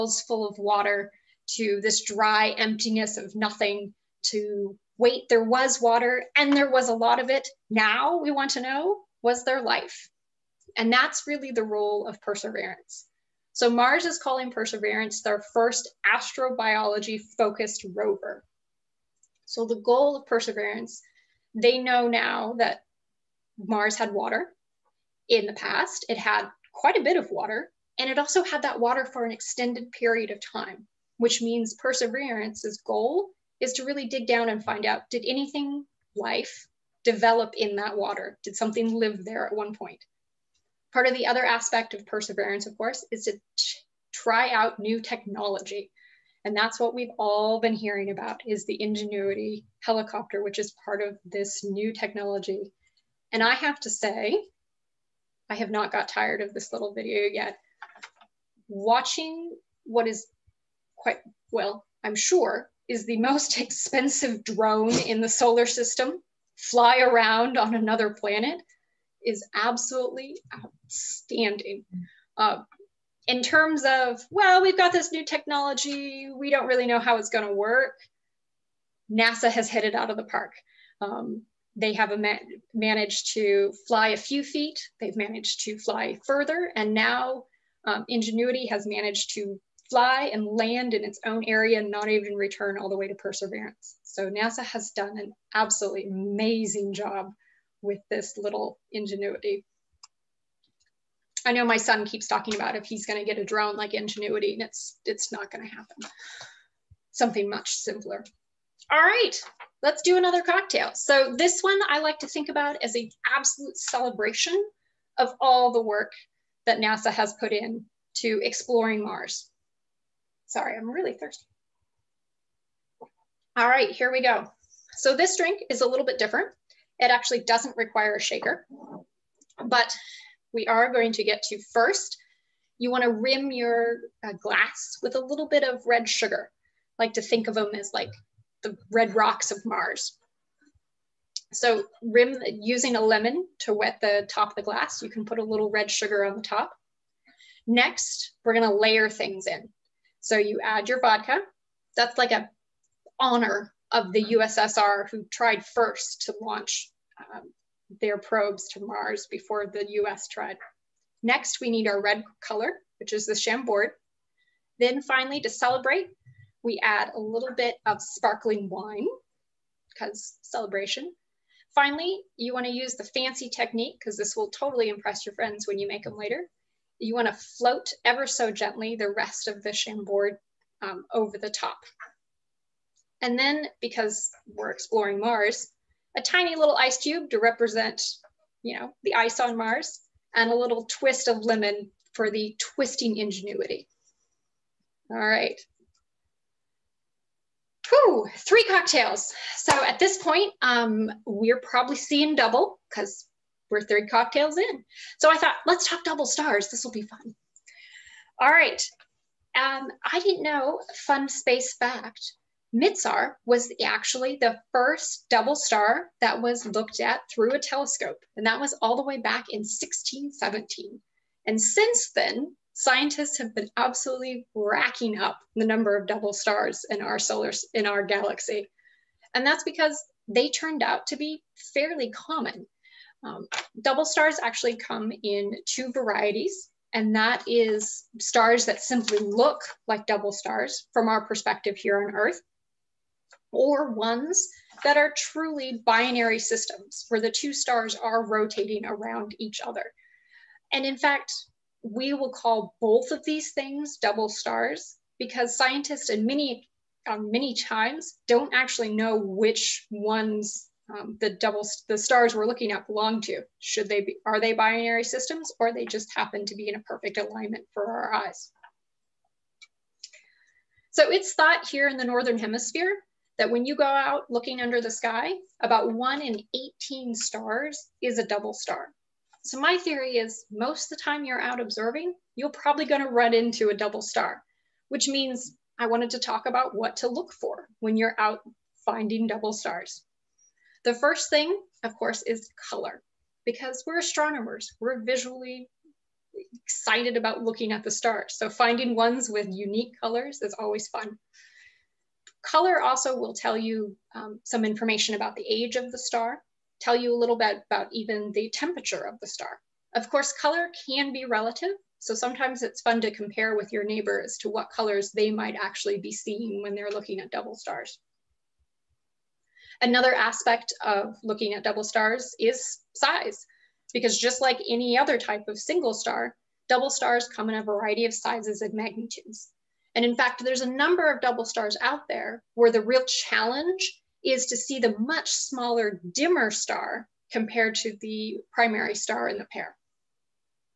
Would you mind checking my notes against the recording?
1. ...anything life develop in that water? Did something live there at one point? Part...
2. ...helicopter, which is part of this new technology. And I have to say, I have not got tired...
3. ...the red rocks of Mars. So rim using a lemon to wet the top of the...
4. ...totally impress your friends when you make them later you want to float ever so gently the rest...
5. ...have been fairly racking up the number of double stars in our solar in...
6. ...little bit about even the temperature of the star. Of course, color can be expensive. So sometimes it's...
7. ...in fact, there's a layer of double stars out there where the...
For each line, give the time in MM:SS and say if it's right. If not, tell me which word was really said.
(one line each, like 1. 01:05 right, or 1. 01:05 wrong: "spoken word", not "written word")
1. 00:35 right
2. 00:49 right
3. 02:18 right
4. 02:54 right
5. 03:43 wrong: "absolutely", not "fairly"
6. 05:07 wrong: "relative", not "expensive"
7. 05:30 wrong: "number", not "layer".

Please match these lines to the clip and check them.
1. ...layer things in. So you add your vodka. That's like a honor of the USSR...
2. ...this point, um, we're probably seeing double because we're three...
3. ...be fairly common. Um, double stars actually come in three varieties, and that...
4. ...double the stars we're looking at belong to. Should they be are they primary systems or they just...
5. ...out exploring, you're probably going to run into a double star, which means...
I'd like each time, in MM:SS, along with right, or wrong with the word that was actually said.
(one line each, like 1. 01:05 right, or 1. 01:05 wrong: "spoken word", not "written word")
1. 02:28 right
2. 03:19 right
3. 03:51 wrong: "two", not "three"
4. 04:21 wrong: "binary", not "primary"
5. 04:41 wrong: "observing", not "exploring".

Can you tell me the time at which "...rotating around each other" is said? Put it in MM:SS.
04:08.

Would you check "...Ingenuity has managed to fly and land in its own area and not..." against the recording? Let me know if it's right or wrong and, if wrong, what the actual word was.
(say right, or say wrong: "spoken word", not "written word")
right.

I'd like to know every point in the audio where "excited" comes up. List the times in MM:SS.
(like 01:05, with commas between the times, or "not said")
04:56.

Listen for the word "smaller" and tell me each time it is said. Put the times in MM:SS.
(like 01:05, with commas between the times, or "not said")
05:35.